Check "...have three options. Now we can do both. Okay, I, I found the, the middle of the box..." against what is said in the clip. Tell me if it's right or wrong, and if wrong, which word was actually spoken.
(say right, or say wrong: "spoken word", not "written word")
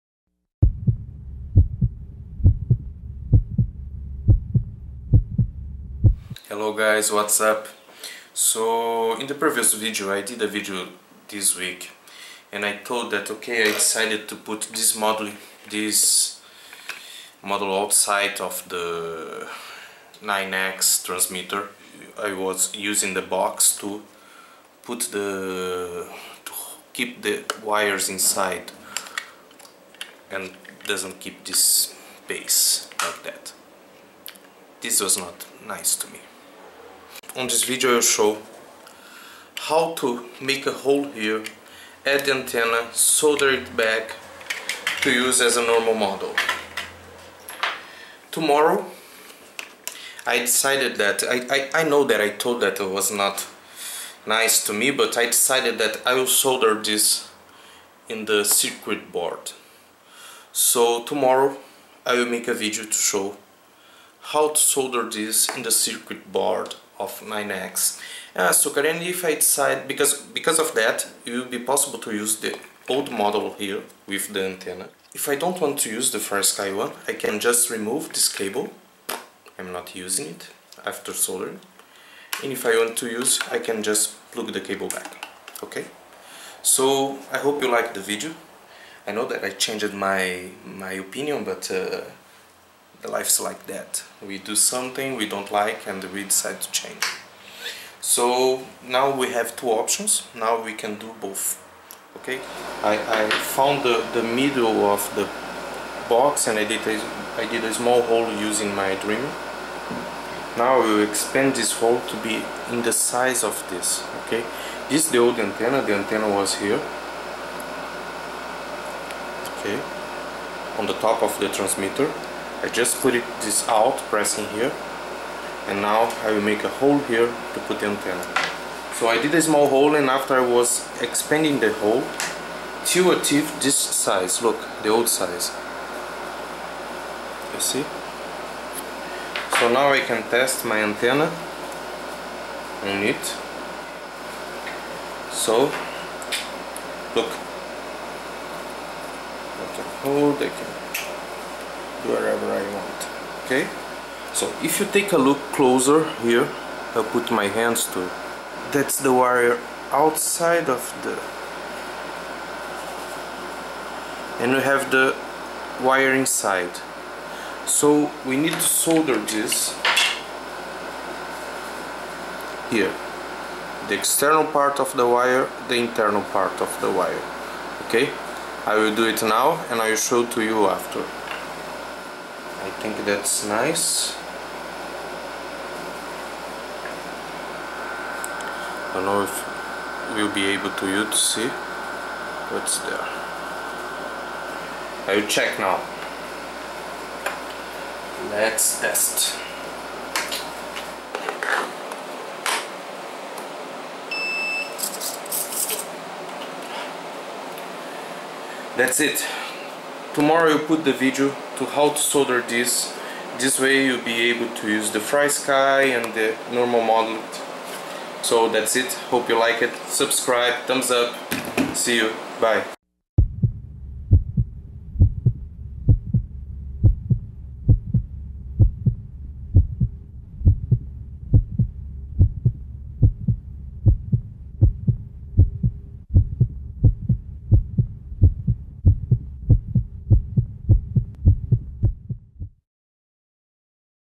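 wrong: "two", not "three".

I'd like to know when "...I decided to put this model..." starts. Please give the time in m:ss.
0:13.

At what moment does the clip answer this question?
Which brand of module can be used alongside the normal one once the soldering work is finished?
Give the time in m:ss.
3:34.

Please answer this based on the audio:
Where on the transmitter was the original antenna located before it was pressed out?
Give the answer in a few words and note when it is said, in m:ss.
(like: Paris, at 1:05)
The top, at 2:00.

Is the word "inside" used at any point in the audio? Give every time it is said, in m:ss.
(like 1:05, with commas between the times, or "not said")
0:28, 2:46.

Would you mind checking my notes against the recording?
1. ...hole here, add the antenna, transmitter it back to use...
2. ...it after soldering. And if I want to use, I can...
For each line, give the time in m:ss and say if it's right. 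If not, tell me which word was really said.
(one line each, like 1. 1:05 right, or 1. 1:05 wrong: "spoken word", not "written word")
1. 0:40 wrong: "solder", not "transmitter"
2. 1:20 right.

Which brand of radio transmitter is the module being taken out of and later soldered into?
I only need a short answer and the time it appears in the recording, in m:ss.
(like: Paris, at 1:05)
9x, at 0:20.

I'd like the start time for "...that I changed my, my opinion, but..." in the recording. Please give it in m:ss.
1:29.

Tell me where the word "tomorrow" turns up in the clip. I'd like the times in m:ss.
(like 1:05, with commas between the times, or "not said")
0:48, 1:01, 3:30.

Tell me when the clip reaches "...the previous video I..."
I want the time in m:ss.
0:09.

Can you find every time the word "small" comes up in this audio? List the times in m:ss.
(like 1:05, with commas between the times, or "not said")
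1:47, 2:09.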